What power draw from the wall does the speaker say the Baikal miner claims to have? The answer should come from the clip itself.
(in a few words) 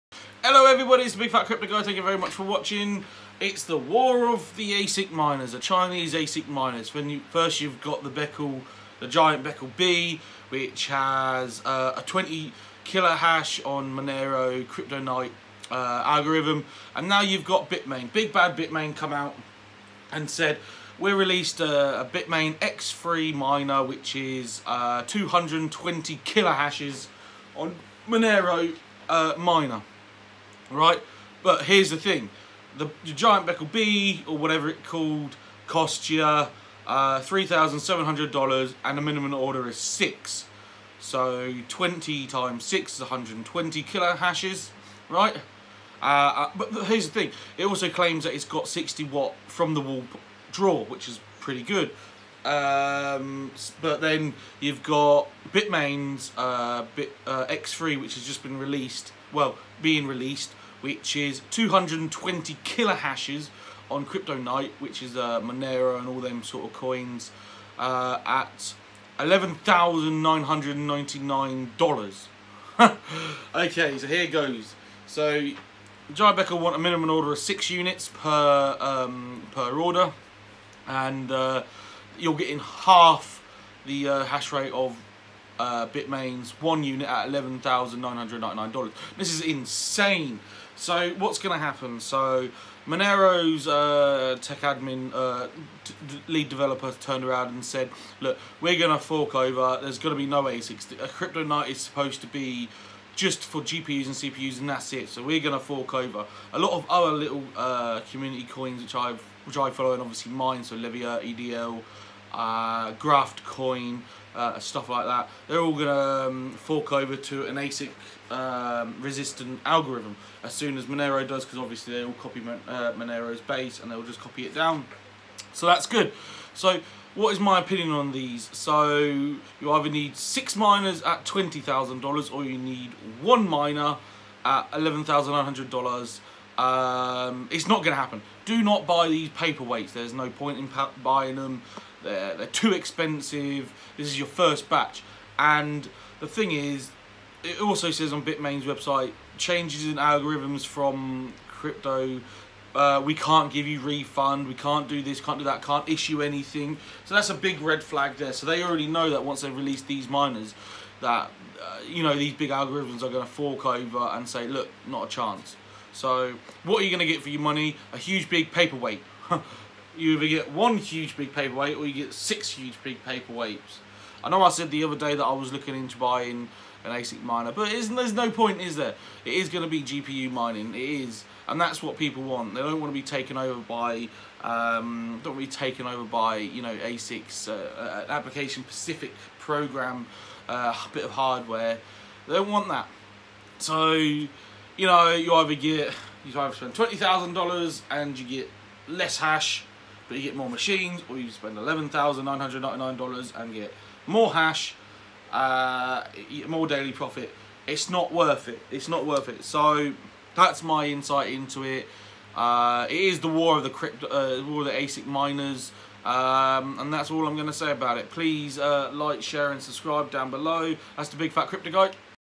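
60 watt.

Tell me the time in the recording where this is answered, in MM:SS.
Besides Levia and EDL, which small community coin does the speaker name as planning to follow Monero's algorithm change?
01:52.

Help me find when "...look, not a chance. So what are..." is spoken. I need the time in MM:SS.
02:44.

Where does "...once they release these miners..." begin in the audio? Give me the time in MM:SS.
02:39.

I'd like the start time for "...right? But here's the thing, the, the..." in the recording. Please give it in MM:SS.
00:30.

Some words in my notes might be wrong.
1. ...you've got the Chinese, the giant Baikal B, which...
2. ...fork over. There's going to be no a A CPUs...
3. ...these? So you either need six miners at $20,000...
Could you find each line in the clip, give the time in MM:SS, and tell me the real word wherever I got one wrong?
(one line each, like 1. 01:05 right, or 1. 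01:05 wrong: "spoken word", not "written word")
1. 00:07 wrong: "Baikal", not "Chinese"
2. 01:39 wrong: "CryptoNight", not "CPUs"
3. 02:08 right.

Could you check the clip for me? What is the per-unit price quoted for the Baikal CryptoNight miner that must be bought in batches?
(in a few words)
$3,700.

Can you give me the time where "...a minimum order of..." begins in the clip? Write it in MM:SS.
01:16.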